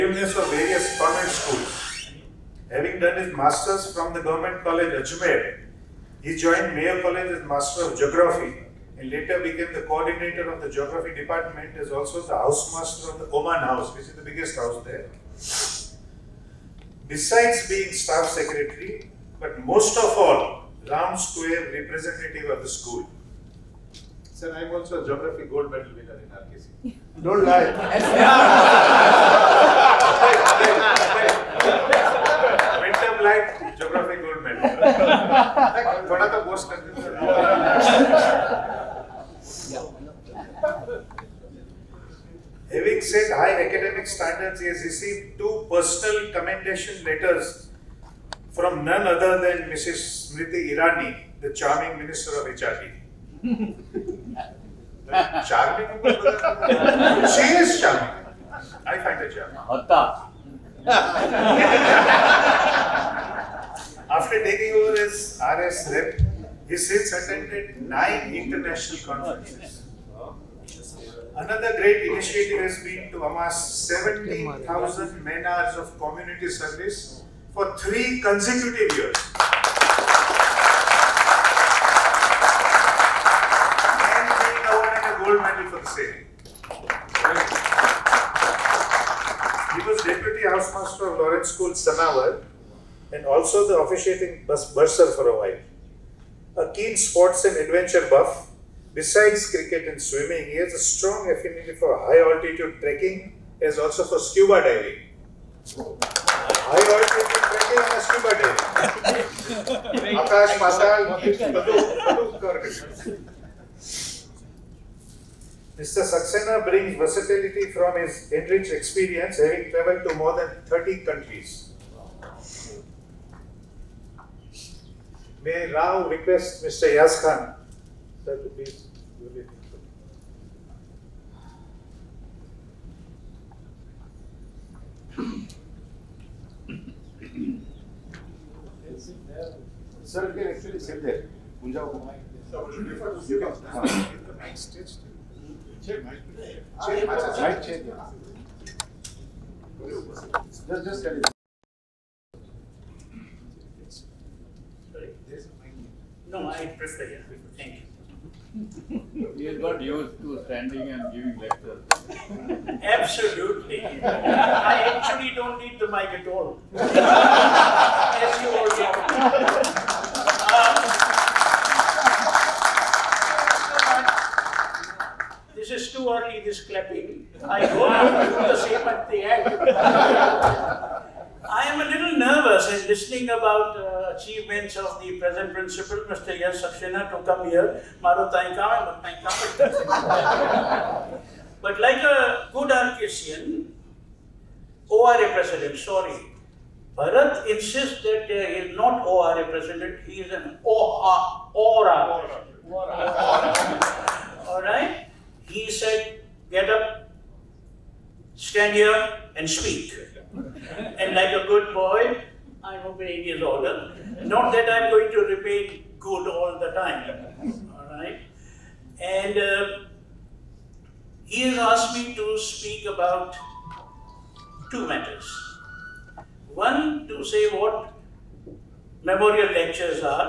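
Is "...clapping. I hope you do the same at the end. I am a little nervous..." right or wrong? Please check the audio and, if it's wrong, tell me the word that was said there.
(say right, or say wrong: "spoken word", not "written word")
right.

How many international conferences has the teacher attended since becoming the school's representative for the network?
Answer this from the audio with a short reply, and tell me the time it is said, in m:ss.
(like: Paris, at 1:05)
9, at 1:07.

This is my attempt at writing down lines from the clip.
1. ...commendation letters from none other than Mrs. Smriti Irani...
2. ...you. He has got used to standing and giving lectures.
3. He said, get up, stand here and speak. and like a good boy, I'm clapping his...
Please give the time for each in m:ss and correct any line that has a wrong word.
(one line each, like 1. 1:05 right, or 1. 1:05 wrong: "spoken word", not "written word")
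1. 0:46 right
2. 2:38 right
3. 3:25 wrong: "obeying", not "clapping".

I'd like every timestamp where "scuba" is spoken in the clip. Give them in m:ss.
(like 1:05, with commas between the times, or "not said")
1:44, 1:49.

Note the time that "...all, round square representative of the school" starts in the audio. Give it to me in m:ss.
0:20.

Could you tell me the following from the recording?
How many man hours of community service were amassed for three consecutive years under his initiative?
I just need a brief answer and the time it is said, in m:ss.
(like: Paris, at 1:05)
17,000, at 1:13.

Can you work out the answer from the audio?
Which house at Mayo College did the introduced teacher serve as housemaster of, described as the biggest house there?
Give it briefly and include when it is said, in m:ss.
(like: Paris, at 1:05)
Oman House, at 0:13.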